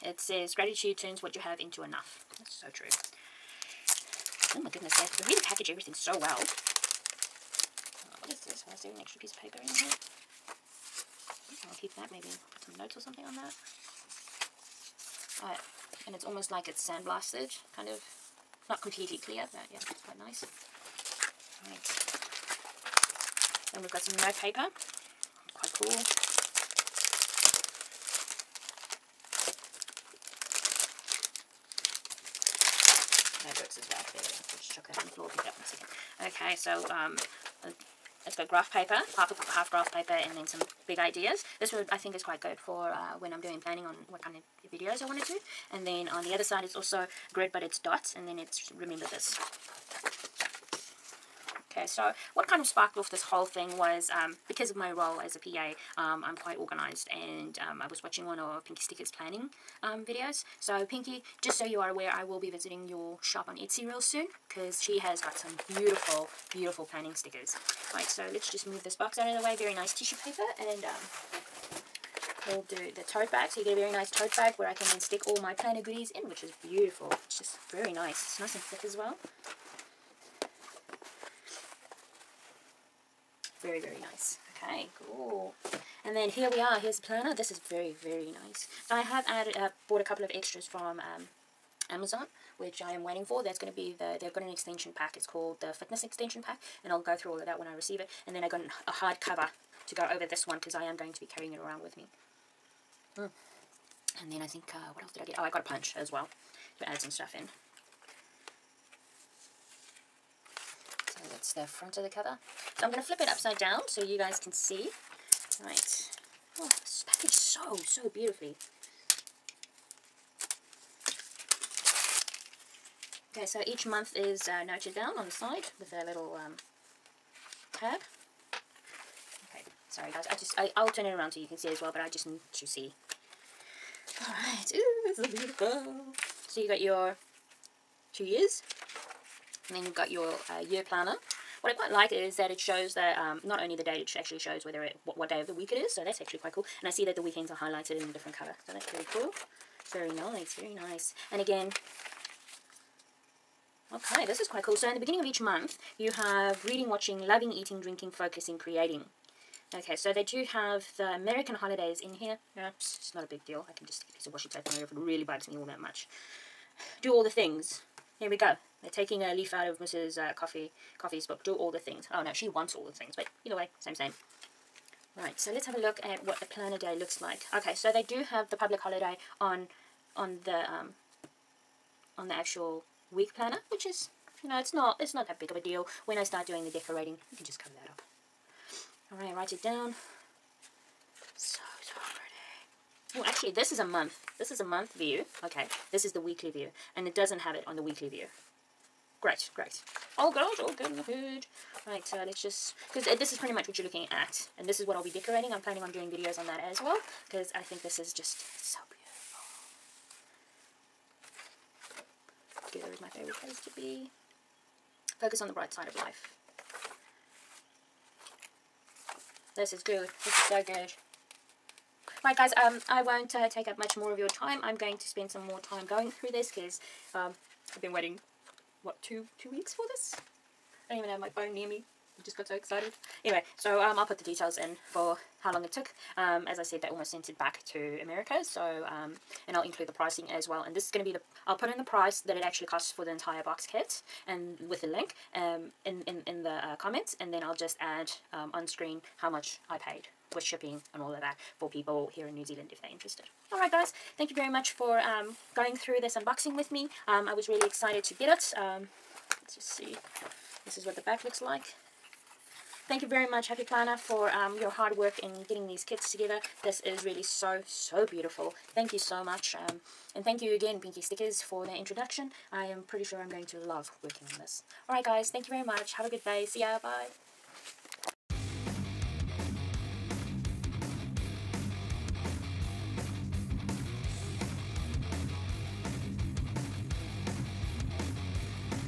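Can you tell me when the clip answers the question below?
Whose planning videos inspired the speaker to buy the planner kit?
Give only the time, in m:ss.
0:58.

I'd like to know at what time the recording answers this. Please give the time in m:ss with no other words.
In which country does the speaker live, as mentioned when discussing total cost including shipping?
4:12.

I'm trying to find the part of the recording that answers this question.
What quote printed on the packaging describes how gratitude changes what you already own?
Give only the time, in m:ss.
0:00.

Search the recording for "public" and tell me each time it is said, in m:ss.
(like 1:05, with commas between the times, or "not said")
2:58.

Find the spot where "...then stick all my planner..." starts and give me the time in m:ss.
1:14.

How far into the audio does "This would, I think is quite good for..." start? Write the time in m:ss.
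0:41.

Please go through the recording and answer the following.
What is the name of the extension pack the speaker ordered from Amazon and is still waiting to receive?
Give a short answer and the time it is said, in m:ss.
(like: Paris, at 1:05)
Fitness extension pack, at 1:35.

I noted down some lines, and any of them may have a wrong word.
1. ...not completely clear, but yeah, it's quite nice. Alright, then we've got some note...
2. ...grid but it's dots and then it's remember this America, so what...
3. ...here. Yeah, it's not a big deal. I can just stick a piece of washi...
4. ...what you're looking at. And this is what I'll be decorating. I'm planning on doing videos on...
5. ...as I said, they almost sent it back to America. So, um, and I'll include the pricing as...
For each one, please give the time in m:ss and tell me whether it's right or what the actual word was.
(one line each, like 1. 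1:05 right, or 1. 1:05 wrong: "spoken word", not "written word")
1. 0:18 right
2. 0:47 wrong: "Okay", not "America"
3. 2:42 right
4. 3:23 right
5. 3:56 right.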